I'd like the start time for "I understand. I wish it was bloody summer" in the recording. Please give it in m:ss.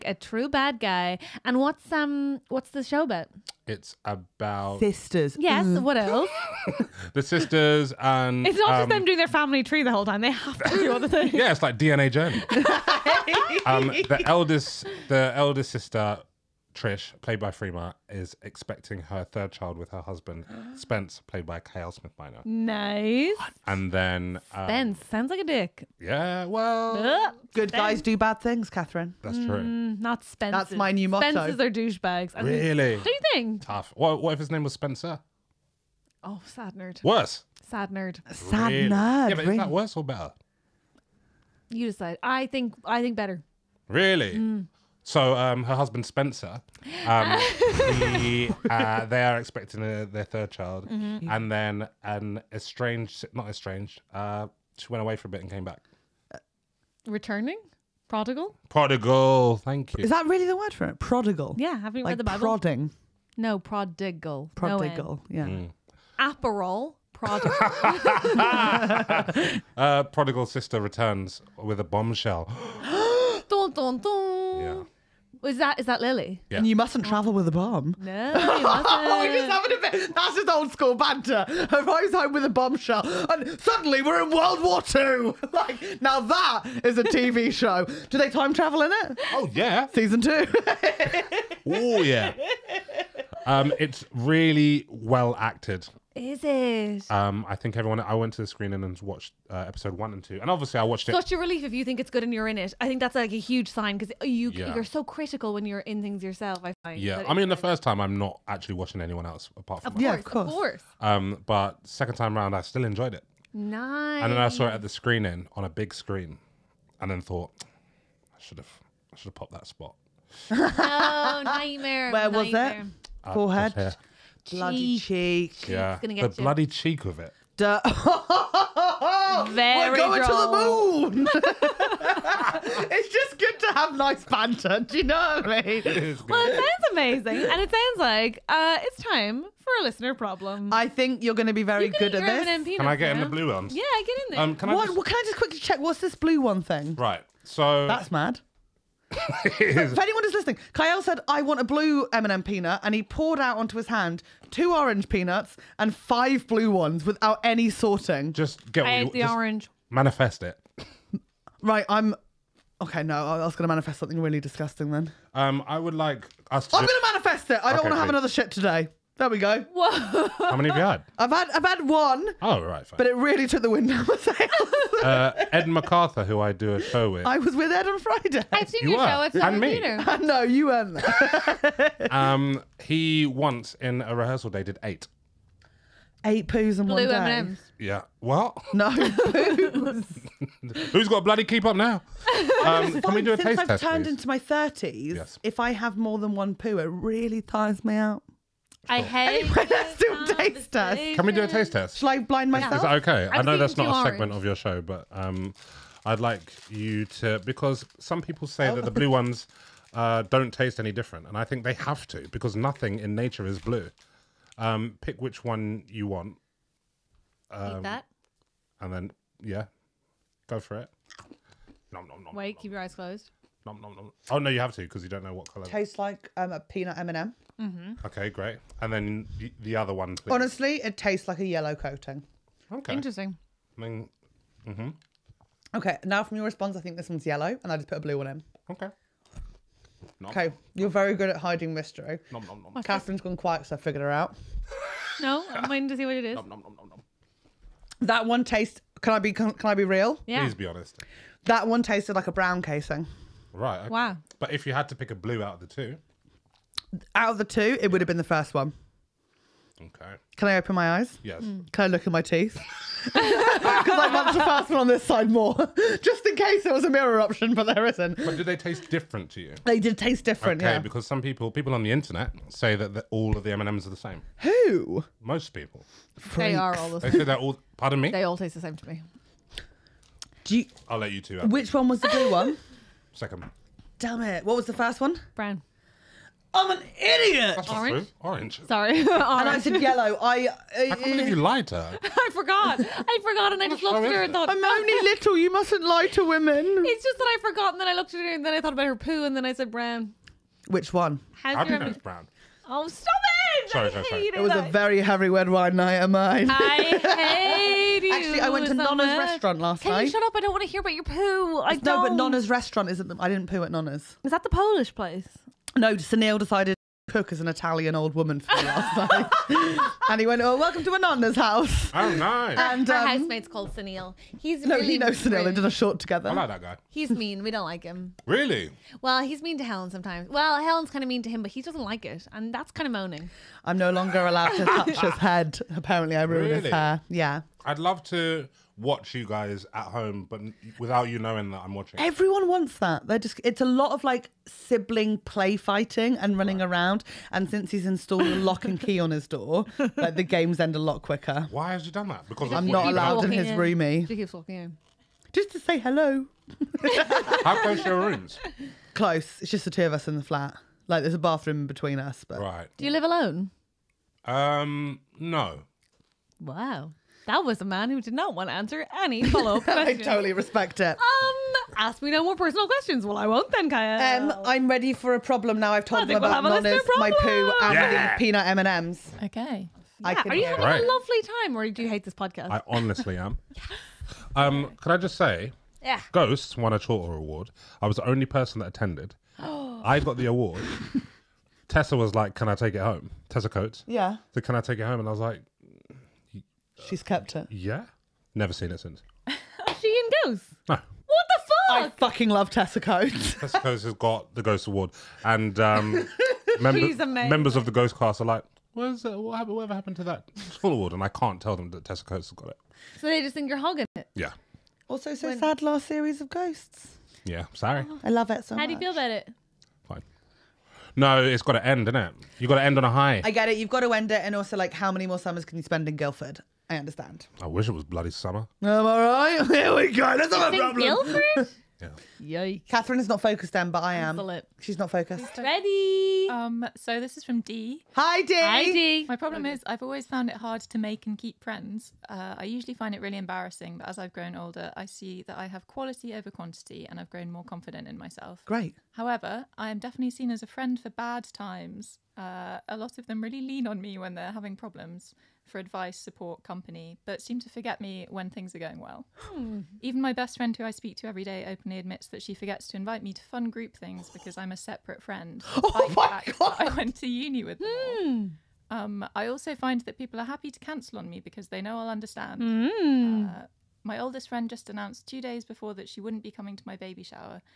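7:06.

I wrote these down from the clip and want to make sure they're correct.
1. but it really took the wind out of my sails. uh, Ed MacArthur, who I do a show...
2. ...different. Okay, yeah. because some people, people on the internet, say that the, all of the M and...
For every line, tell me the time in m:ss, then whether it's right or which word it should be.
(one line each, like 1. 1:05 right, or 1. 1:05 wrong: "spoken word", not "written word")
1. 2:52 right
2. 4:30 right.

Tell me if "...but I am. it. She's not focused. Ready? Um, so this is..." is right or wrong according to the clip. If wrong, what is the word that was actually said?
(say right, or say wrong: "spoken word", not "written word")
right.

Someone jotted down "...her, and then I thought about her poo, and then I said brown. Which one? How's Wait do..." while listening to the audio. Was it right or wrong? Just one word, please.
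wrong.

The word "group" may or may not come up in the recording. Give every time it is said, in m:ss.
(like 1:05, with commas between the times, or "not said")
7:43.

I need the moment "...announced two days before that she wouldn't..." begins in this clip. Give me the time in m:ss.
7:54.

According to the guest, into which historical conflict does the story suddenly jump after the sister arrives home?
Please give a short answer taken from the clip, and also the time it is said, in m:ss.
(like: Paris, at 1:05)
World War Two, at 1:24.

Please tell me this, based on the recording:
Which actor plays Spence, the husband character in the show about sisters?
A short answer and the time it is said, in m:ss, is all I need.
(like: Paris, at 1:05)
Kiell Smith Bynoe, at 0:21.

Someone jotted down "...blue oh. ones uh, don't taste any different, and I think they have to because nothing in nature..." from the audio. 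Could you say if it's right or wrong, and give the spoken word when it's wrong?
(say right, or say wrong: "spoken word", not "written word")
right.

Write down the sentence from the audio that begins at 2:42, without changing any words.
Okay, no, I was going to manifest something really disgusting then.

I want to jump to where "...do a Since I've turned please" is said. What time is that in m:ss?
3:13.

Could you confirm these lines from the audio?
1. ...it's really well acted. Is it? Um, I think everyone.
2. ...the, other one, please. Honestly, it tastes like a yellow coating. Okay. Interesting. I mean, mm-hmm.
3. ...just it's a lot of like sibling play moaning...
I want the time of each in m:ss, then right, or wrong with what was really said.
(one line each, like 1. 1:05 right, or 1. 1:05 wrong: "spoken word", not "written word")
1. 1:33 right
2. 3:49 right
3. 5:43 wrong: "fighting", not "moaning".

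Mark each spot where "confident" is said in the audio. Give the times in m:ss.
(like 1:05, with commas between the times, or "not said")
7:27.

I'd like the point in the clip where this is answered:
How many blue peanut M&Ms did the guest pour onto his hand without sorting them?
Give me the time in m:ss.
2:35.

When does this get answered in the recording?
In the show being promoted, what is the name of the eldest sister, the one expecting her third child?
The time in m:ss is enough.
0:16.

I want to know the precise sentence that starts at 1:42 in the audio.
I think that's like a huge sign because you yeah.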